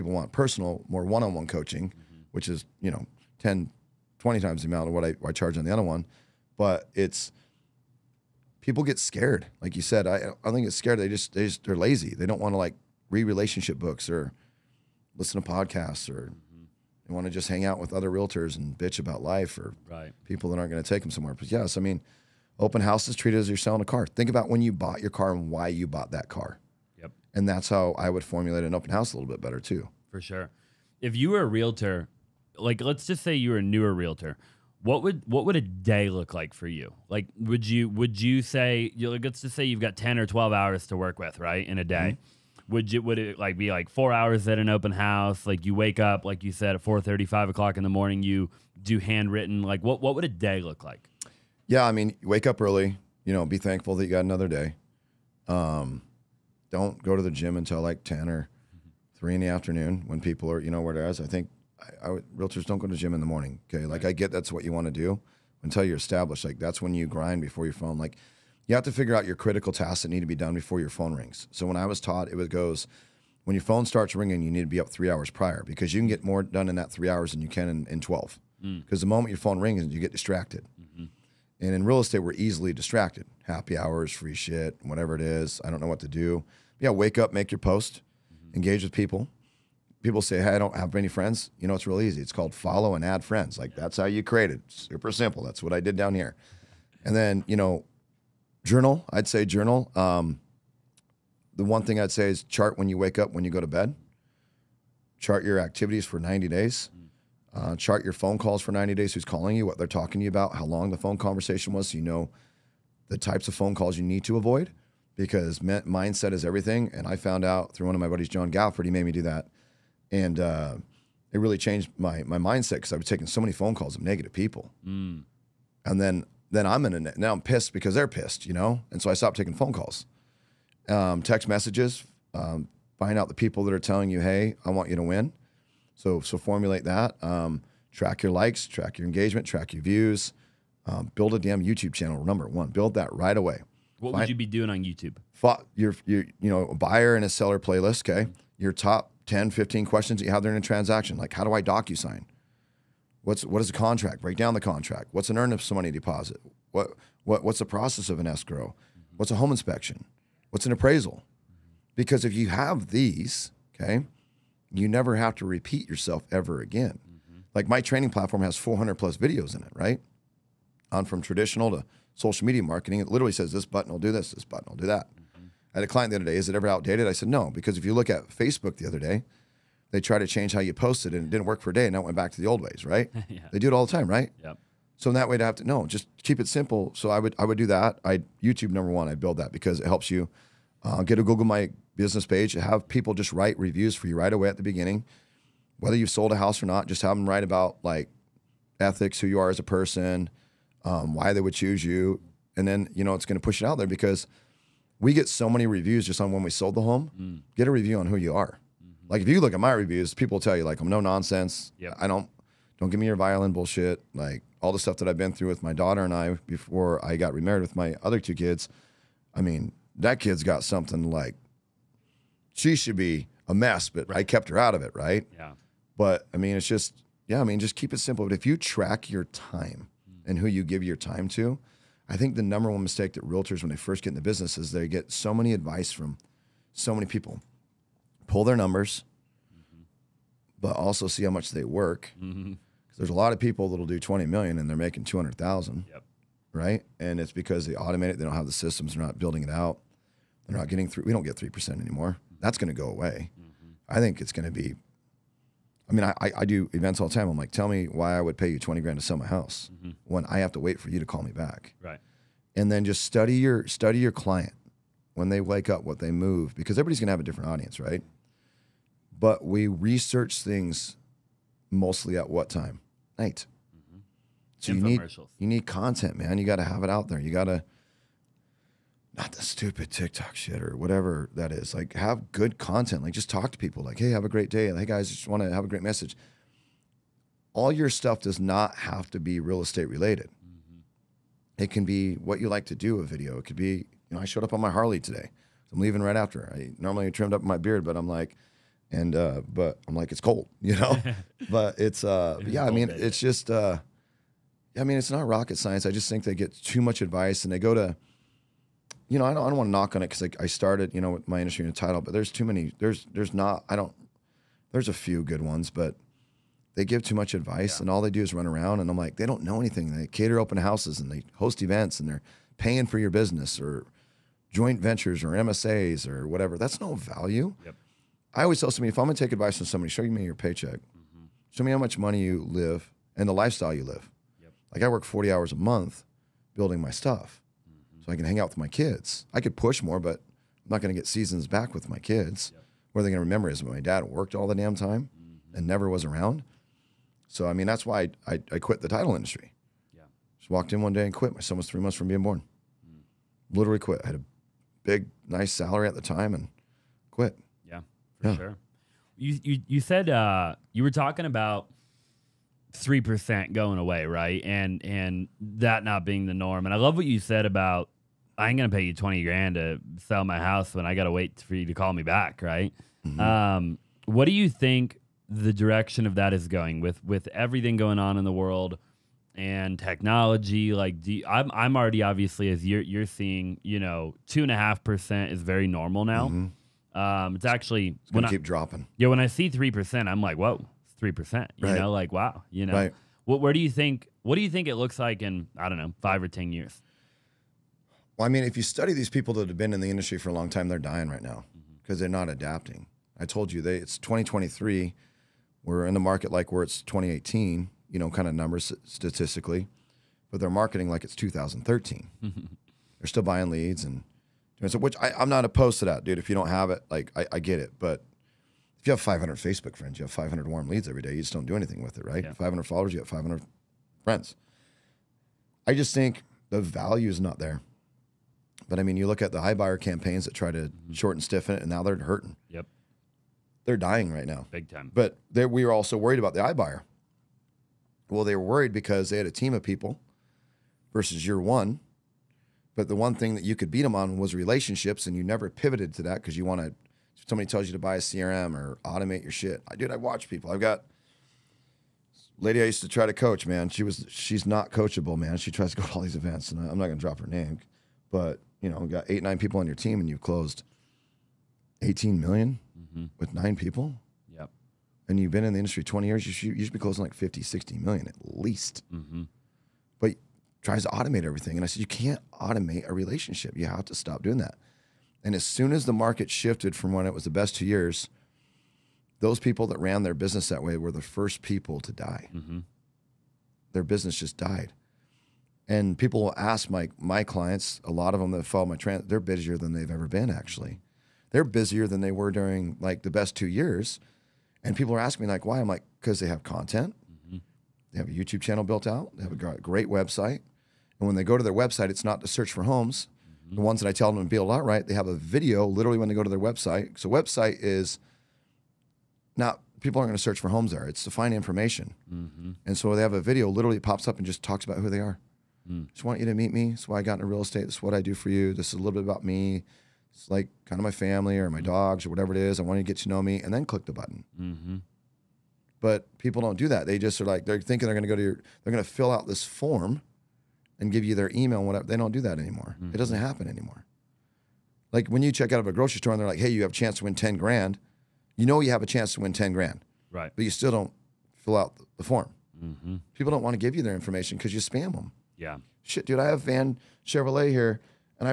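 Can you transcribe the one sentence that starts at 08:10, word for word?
Actually, they're busier than they were during like the best two years.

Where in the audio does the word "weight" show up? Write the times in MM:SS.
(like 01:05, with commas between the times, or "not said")
not said.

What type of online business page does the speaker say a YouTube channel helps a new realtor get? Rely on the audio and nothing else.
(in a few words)
Google My Business.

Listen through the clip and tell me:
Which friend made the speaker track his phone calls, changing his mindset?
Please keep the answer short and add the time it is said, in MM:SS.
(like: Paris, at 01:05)
John Galford, at 01:58.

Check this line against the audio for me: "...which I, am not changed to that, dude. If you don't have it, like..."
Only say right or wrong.
wrong.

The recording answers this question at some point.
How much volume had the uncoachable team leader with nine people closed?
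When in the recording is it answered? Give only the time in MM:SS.
07:41.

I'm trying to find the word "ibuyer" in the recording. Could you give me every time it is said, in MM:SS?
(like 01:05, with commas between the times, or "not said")
07:09, 07:16.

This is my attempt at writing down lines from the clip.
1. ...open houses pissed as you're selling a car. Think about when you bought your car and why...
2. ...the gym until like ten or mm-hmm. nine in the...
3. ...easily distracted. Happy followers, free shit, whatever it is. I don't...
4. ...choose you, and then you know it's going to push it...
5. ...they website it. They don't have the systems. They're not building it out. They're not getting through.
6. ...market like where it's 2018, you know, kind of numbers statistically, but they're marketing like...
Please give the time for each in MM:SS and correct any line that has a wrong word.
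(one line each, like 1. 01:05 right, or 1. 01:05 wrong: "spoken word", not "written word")
1. 00:22 wrong: "treated", not "pissed"
2. 00:57 wrong: "three", not "nine"
3. 01:22 wrong: "hours", not "followers"
4. 03:21 right
5. 04:07 wrong: "automate", not "website"
6. 06:45 right.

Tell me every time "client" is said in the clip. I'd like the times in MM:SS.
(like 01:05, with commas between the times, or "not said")
02:55, 04:24, 08:07.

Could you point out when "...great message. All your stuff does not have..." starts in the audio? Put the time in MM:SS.
04:45.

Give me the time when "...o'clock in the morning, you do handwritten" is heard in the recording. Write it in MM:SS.
00:47.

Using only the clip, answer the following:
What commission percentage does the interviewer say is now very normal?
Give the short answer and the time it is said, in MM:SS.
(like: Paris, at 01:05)
2.5%, at 06:24.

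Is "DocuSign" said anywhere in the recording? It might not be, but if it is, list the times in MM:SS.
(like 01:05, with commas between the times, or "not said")
02:31.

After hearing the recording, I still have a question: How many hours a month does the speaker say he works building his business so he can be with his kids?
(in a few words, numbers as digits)
40.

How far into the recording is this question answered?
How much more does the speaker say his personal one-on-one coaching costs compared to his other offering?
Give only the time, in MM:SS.
00:03.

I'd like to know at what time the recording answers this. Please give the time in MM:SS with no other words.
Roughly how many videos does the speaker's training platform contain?
02:48.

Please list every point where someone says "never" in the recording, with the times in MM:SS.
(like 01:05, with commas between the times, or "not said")
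02:44, 05:45, 07:25.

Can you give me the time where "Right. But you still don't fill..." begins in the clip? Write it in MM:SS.
09:00.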